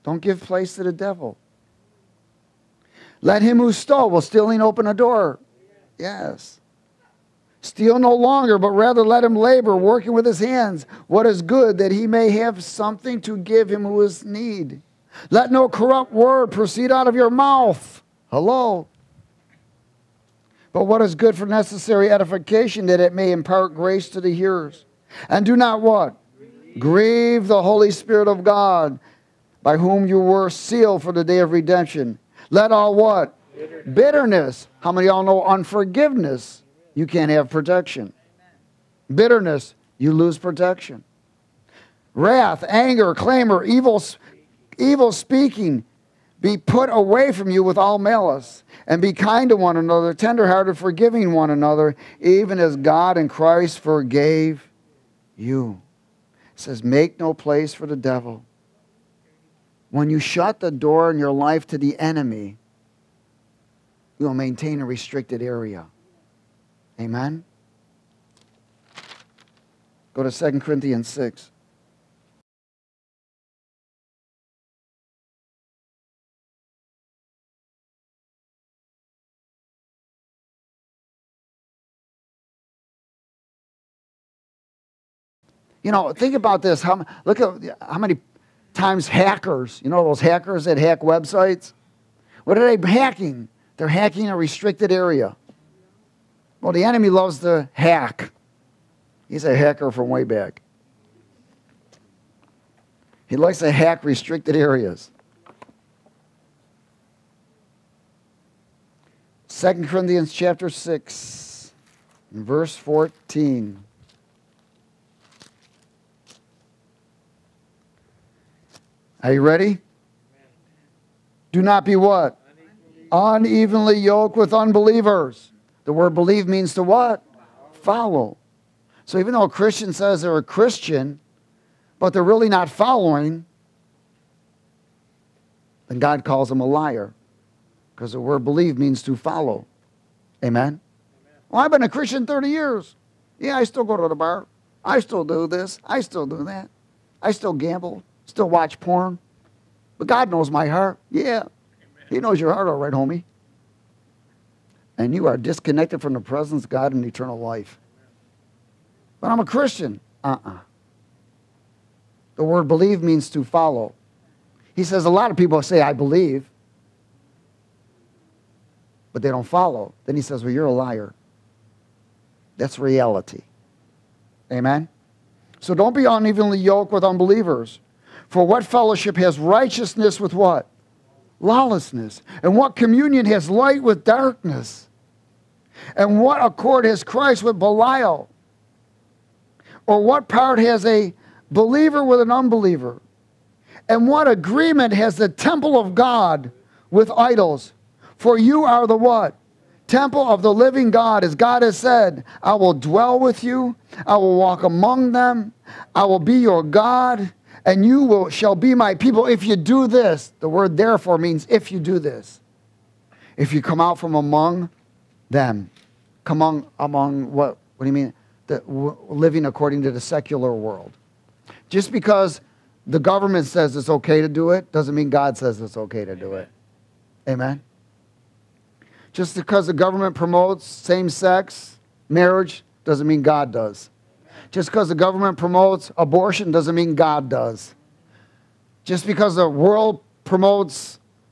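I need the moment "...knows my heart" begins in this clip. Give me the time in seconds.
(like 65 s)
150 s.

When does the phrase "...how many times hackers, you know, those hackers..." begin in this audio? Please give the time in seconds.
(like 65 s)
87 s.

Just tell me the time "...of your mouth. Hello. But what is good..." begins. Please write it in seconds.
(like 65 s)
17 s.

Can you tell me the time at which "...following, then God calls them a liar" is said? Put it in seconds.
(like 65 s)
132 s.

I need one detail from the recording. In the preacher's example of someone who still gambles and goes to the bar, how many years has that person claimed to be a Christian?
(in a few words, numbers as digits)
30.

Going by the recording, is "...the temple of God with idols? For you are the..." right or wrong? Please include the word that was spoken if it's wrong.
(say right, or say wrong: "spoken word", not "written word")
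right.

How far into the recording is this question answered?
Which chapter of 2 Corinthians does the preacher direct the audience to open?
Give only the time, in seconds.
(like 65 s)
70 s.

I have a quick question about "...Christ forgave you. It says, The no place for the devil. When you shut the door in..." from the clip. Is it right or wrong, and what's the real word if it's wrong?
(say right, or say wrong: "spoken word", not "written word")
wrong: "Make", not "The".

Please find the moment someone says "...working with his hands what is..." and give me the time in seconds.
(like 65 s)
9 s.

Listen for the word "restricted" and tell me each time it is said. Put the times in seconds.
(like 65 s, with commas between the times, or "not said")
64 s, 94 s, 104 s.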